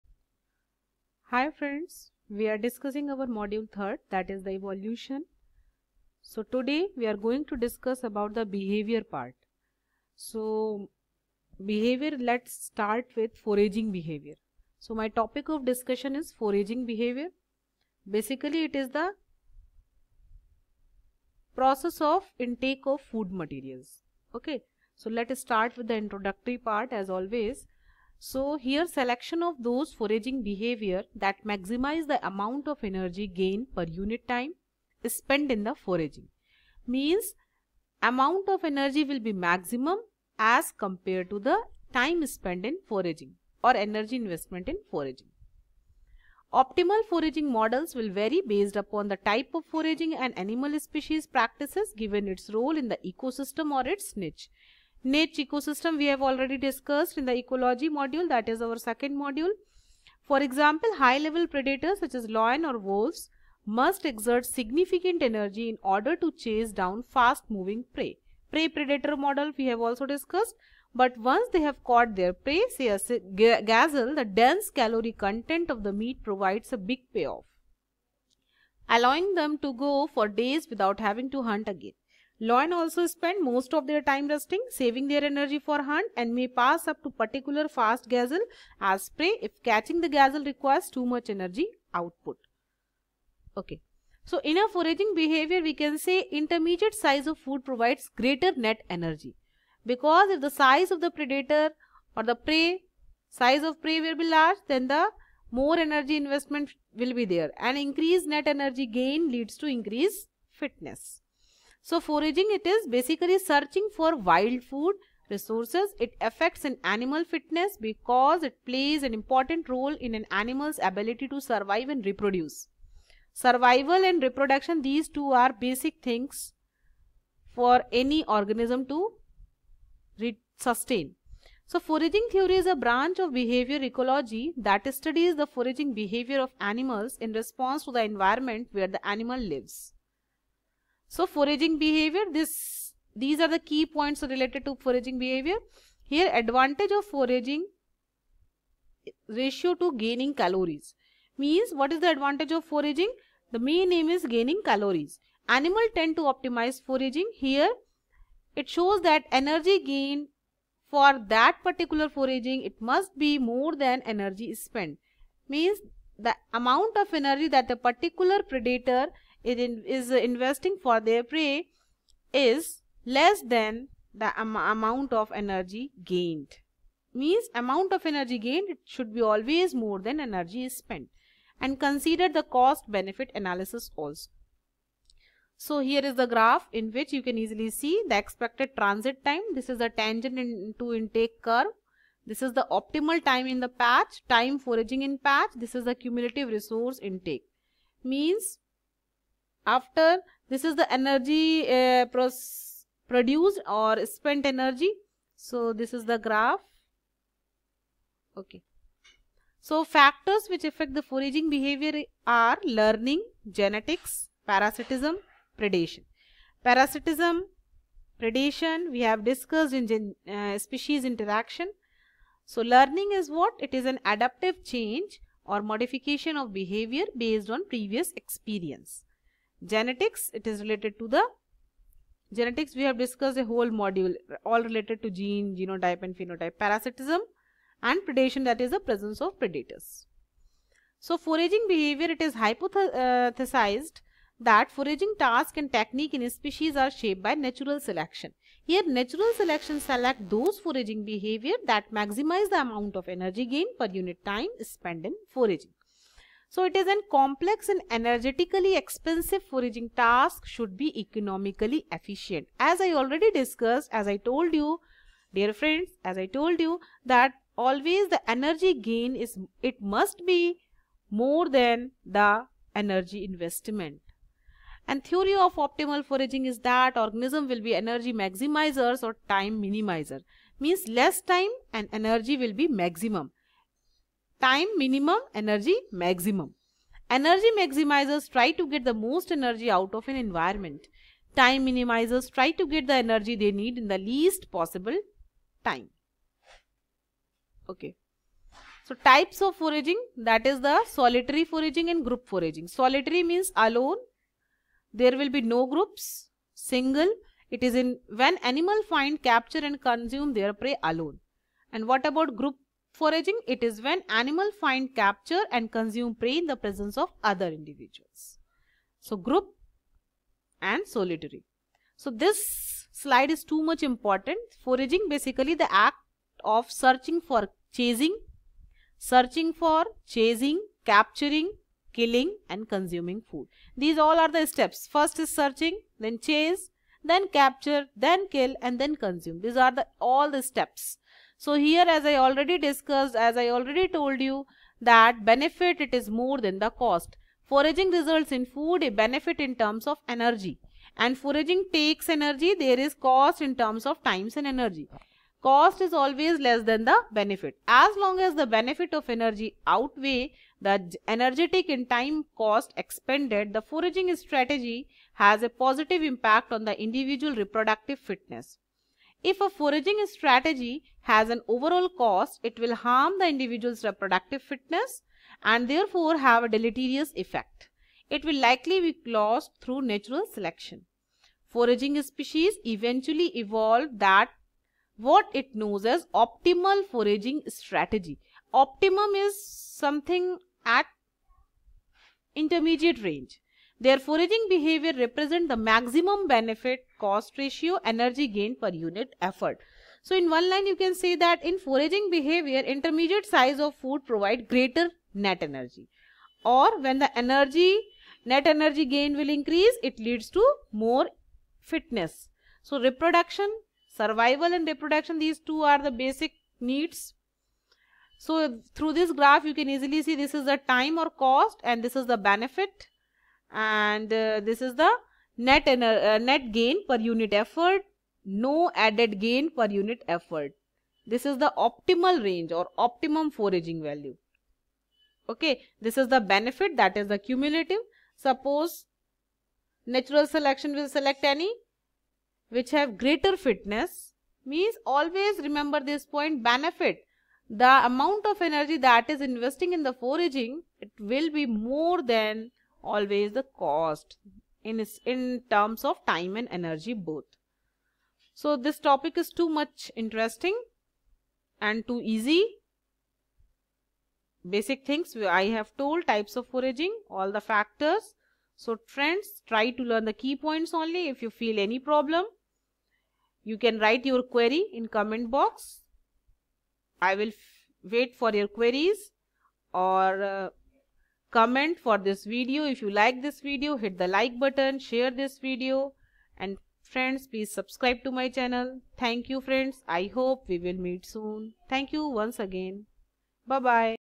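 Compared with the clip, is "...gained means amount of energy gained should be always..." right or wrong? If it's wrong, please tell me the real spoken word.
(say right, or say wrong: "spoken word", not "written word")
right.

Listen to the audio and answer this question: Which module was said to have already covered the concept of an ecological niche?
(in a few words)
Ecology module.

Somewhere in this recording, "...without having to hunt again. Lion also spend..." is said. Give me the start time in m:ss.
1:20.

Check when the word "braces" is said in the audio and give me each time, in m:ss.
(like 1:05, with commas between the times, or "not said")
not said.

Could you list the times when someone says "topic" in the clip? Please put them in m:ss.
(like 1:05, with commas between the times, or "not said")
0:15, 7:38.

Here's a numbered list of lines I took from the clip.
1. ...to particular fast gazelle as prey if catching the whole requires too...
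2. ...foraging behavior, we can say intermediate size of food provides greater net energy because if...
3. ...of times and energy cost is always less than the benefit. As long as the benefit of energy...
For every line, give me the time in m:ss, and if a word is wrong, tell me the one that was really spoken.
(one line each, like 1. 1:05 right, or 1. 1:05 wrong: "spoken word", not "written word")
1. 1:27 wrong: "gazelle", not "whole"
2. 1:34 right
3. 5:53 right.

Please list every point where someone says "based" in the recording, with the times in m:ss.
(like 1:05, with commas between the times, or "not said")
0:48, 3:47.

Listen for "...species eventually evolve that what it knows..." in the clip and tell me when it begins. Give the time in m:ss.
6:22.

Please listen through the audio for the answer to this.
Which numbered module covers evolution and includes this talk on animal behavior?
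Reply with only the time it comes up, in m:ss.
0:03.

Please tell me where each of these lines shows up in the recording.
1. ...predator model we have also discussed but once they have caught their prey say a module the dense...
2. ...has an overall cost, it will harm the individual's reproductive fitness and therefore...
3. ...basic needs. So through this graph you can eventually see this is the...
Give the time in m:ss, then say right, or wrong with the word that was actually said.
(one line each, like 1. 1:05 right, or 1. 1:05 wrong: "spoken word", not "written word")
1. 1:08 wrong: "gazelle", not "module"
2. 6:11 right
3. 6:55 wrong: "easily", not "eventually".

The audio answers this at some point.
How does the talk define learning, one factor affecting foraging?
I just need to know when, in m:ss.
3:44.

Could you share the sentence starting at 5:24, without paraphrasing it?
Foraging basically the act of searching for chasing, searching for chasing, capturing, killing and consuming food.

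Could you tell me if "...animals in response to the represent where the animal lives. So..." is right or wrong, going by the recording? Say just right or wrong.
wrong.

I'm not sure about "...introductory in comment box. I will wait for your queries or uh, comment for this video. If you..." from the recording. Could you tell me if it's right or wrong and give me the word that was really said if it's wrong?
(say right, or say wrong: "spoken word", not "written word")
wrong: "query", not "introductory".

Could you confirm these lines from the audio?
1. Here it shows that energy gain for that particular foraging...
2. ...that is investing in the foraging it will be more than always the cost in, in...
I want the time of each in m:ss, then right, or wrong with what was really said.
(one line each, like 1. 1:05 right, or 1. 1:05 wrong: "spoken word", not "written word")
1. 2:37 right
2. 7:28 right.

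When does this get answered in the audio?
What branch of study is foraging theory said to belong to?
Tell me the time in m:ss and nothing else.
2:13.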